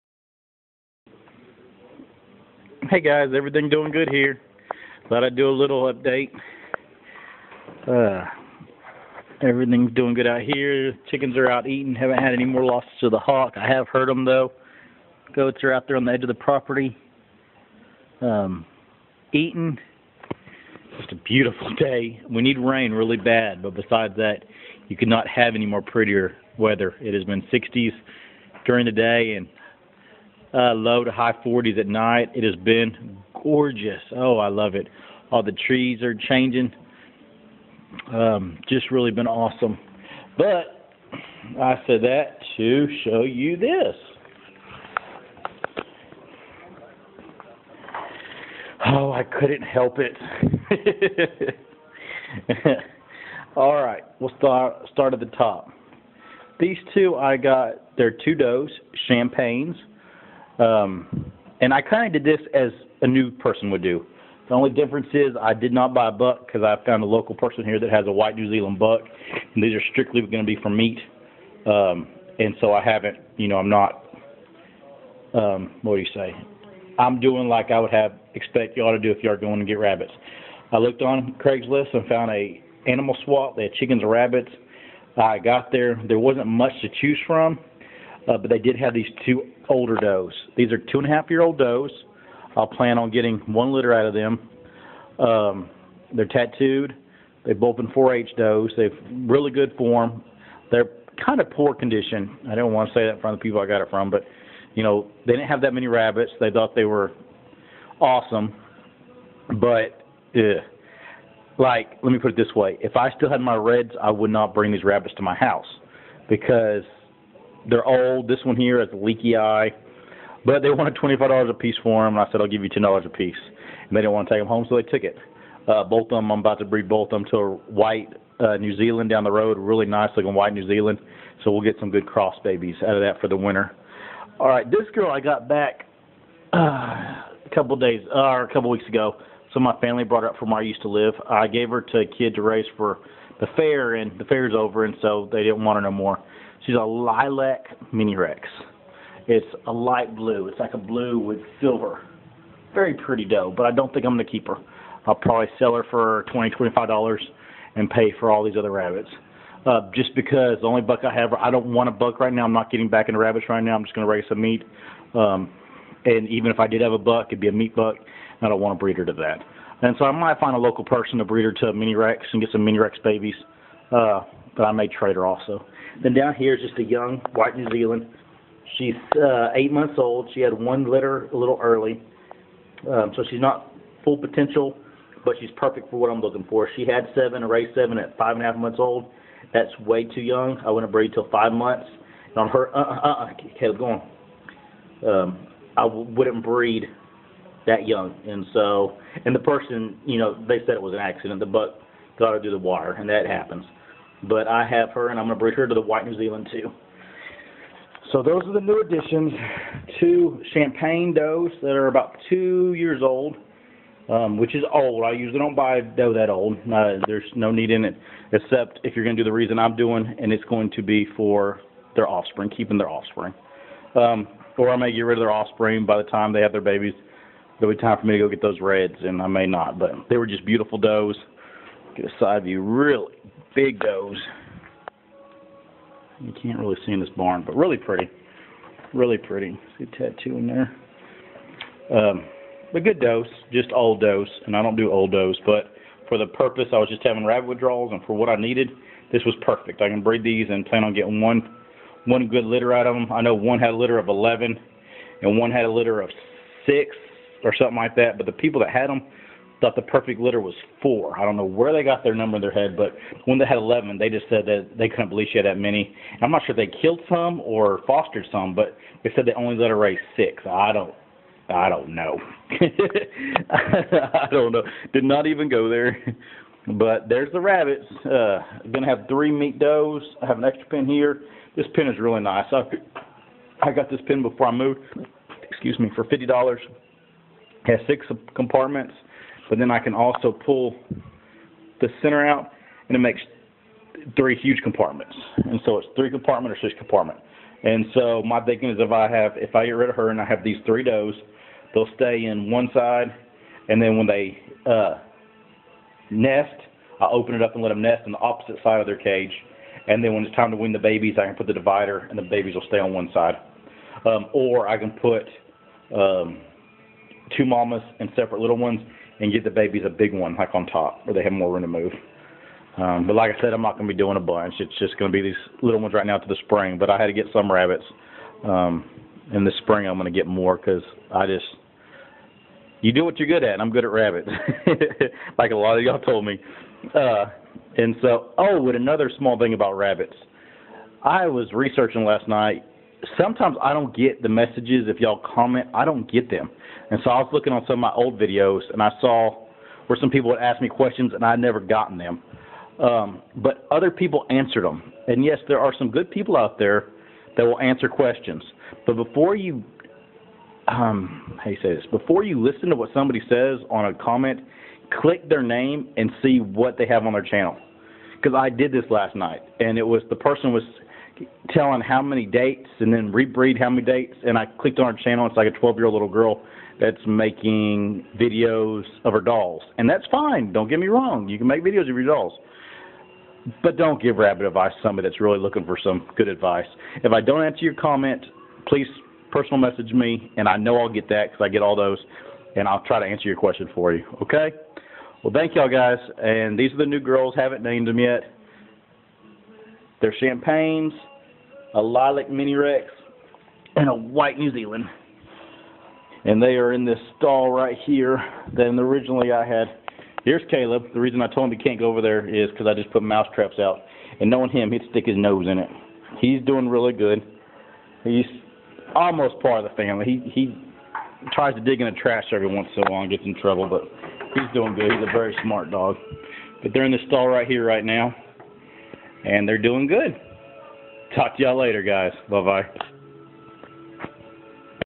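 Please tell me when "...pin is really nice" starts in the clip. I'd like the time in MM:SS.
04:41.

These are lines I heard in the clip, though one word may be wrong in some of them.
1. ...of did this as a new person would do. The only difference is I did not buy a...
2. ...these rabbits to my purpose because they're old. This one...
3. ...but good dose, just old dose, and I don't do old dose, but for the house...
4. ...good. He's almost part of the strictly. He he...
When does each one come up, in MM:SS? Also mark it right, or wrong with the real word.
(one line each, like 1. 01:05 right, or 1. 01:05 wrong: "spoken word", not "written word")
1. 01:02 right
2. 01:54 wrong: "house", not "purpose"
3. 04:02 wrong: "purpose", not "house"
4. 06:56 wrong: "family", not "strictly".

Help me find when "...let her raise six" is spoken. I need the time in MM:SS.
04:29.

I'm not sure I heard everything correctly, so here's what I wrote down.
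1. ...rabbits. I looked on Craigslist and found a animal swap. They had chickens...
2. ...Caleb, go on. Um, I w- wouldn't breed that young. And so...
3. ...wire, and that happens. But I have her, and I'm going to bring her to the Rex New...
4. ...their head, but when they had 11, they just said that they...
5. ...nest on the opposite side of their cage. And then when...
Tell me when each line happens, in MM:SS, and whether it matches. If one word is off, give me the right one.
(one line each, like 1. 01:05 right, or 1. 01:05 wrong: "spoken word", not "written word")
1. 01:19 right
2. 03:13 right
3. 03:22 wrong: "White", not "Rex"
4. 04:22 right
5. 05:07 right.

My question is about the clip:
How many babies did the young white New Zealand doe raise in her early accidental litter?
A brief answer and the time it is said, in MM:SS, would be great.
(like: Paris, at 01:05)
7, at 03:07.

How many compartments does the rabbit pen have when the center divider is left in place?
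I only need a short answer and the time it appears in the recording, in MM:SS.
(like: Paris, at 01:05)
6, at 04:47.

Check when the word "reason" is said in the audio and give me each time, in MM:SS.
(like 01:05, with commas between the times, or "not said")
03:39, 06:50.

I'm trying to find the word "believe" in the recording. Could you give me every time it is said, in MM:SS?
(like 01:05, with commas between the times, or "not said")
04:25.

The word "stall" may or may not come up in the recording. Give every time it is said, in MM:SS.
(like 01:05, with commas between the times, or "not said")
06:47, 07:07.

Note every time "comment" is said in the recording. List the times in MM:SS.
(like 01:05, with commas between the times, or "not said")
05:45, 06:03, 06:27.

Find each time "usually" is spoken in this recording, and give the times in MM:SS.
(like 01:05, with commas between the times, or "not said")
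03:35.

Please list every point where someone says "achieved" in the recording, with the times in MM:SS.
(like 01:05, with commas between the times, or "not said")
not said.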